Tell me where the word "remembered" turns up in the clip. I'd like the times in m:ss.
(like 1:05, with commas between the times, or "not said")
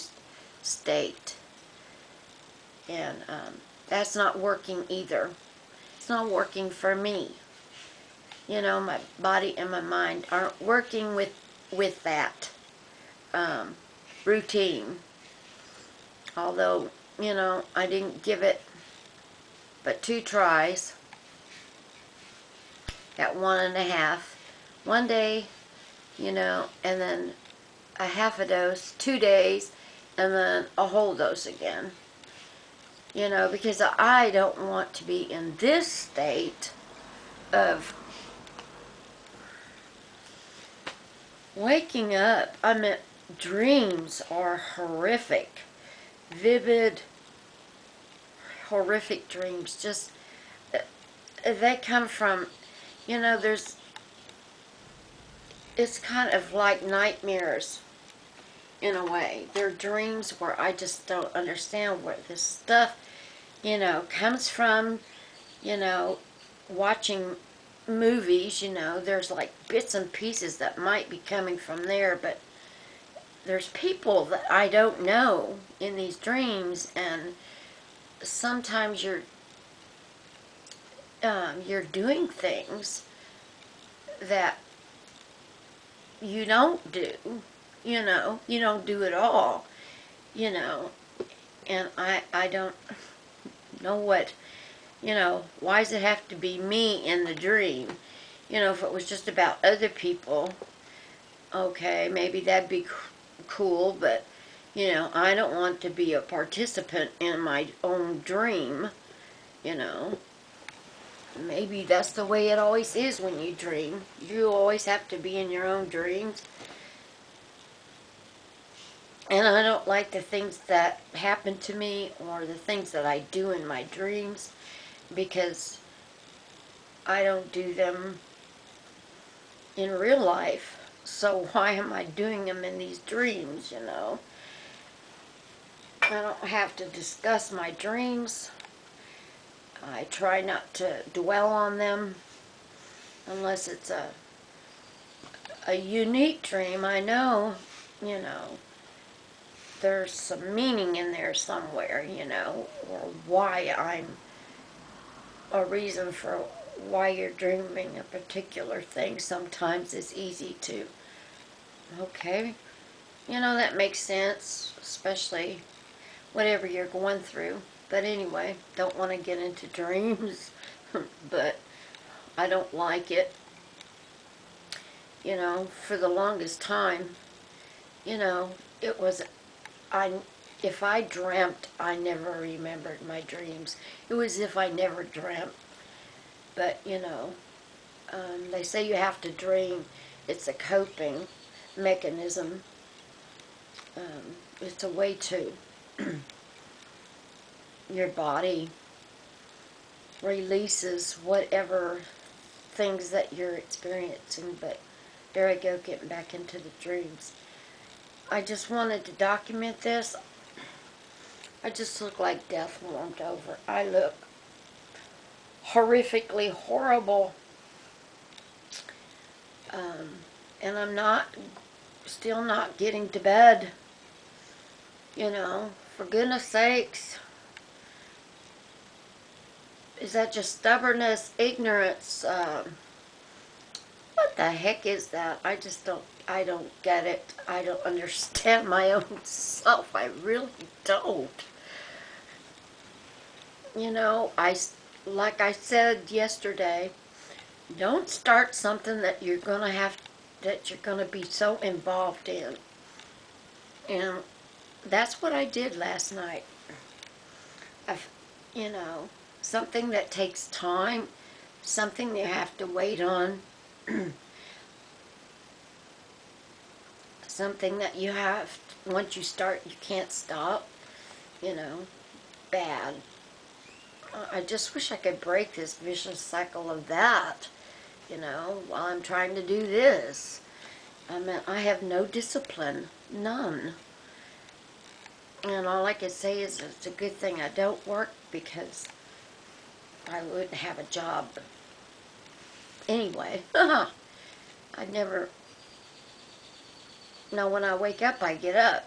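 3:02.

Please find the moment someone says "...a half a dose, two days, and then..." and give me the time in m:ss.
0:27.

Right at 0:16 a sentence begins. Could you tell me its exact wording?
Although, you know, I didn't give it but two tries at one and a half.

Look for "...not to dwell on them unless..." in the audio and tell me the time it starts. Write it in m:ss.
2:20.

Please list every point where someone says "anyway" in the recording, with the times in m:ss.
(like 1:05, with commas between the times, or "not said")
2:48, 4:52.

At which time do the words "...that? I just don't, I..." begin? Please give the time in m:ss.
3:55.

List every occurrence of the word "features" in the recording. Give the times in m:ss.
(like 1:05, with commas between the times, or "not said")
not said.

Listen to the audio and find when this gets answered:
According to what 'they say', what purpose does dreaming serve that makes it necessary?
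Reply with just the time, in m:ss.
3:10.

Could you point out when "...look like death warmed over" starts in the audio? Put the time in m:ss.
3:32.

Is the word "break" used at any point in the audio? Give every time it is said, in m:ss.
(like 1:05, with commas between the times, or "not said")
4:35.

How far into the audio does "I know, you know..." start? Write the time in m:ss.
2:26.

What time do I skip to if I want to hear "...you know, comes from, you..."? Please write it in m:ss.
1:03.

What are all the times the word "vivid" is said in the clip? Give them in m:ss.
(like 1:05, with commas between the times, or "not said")
0:46.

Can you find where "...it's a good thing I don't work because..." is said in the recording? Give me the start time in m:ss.
4:46.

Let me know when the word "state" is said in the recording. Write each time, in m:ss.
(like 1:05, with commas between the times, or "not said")
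0:00, 0:35.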